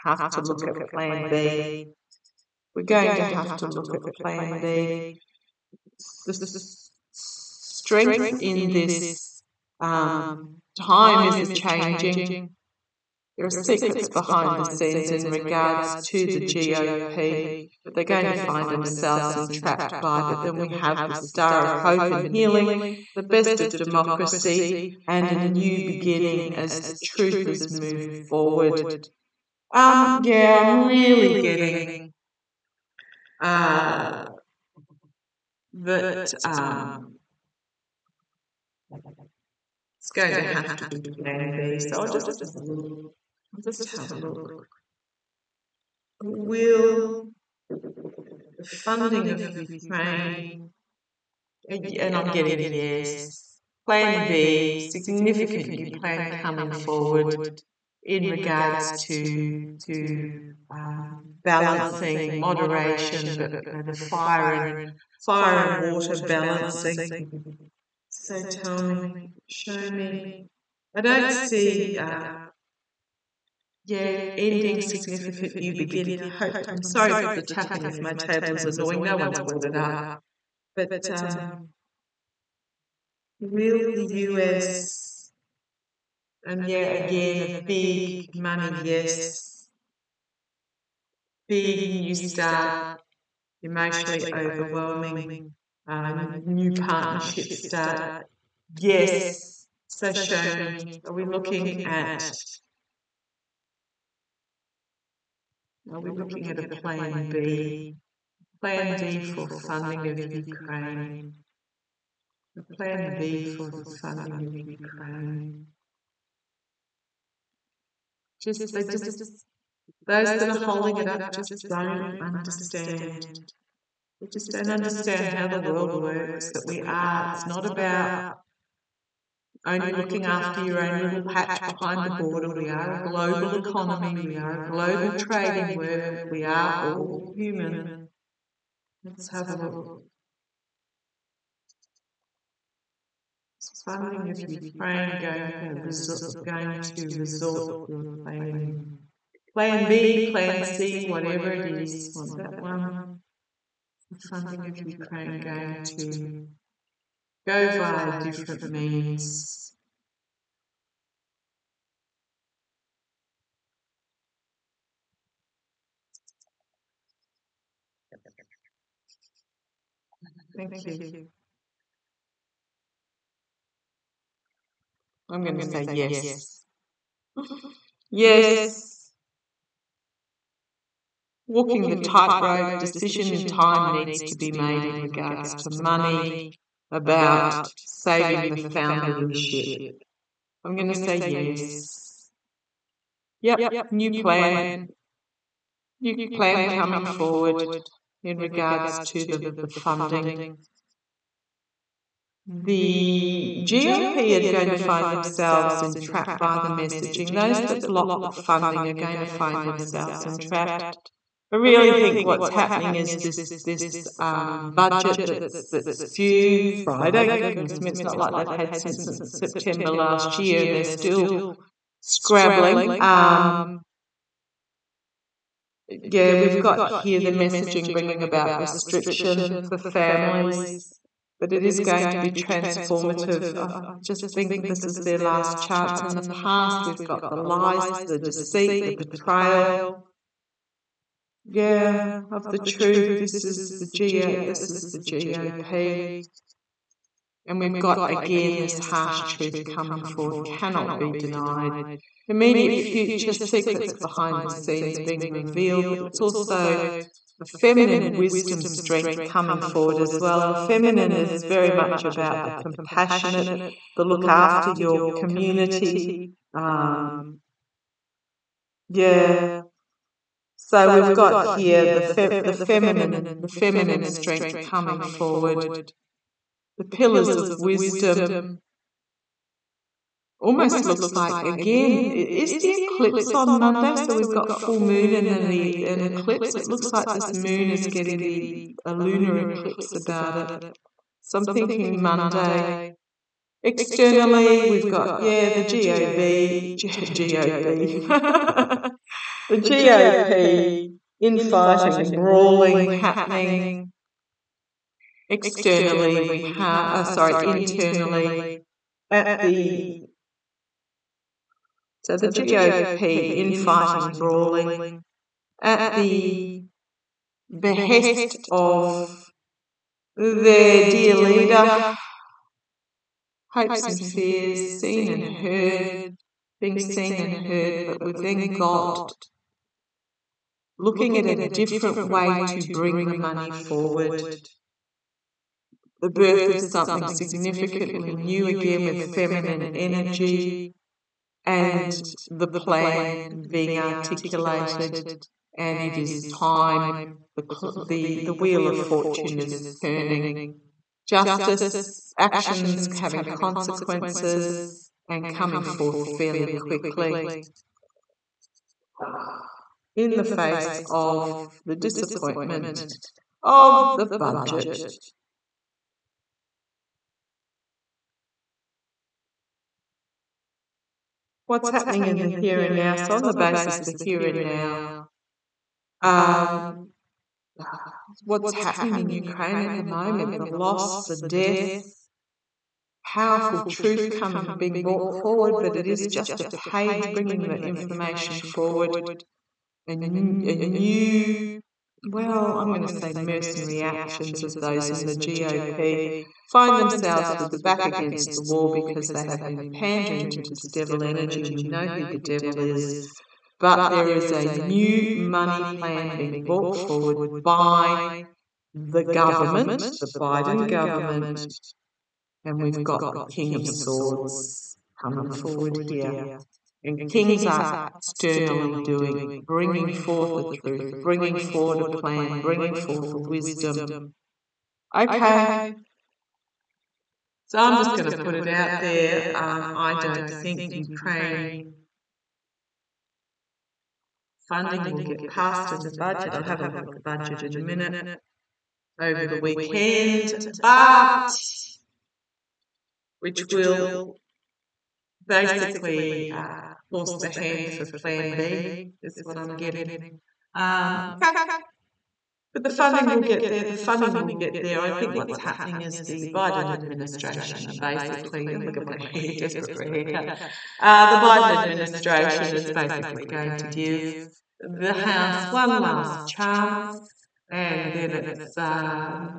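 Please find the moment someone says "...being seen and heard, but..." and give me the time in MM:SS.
05:26.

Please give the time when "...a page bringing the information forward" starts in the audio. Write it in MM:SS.
06:26.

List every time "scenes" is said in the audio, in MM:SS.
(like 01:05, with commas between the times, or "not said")
00:14, 04:14.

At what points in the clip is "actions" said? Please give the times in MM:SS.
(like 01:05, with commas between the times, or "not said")
05:52, 06:33.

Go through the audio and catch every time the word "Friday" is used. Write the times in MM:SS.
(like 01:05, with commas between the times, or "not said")
03:36.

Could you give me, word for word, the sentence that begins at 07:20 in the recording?
But which will basically uh, force the hand for plan B, is what I'm getting.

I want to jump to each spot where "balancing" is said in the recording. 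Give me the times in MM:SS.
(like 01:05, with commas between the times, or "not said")
01:01, 01:06.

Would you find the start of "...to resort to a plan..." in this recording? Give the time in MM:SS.
02:26.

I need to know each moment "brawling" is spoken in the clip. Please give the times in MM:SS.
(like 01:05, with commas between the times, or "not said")
05:02, 05:14.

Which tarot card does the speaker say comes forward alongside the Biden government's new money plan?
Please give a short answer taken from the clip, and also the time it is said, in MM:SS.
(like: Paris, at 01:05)
King of Swords, at 06:53.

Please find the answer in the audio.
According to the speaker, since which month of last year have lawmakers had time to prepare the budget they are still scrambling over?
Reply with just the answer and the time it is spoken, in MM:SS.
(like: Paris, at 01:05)
September, at 03:39.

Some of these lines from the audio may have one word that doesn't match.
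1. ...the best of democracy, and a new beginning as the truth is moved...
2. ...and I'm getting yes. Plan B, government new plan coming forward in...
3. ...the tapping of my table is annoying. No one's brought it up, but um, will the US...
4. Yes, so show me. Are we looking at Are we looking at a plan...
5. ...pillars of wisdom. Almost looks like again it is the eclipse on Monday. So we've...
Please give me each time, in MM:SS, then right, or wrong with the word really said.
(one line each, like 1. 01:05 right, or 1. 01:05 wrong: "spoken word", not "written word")
1. 00:23 right
2. 00:51 wrong: "significant", not "government"
3. 01:17 right
4. 01:38 right
5. 04:36 right.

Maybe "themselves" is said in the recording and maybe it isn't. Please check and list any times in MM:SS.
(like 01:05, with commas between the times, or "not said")
00:18, 03:25, 03:29, 06:36.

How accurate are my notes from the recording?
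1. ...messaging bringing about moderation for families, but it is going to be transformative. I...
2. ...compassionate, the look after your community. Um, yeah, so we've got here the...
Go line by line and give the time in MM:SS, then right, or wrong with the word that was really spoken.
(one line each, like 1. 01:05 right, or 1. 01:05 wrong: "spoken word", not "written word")
1. 03:47 wrong: "restriction", not "moderation"
2. 04:22 right.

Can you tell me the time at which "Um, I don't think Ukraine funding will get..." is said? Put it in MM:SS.
07:09.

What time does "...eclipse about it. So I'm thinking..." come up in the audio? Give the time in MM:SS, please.
04:49.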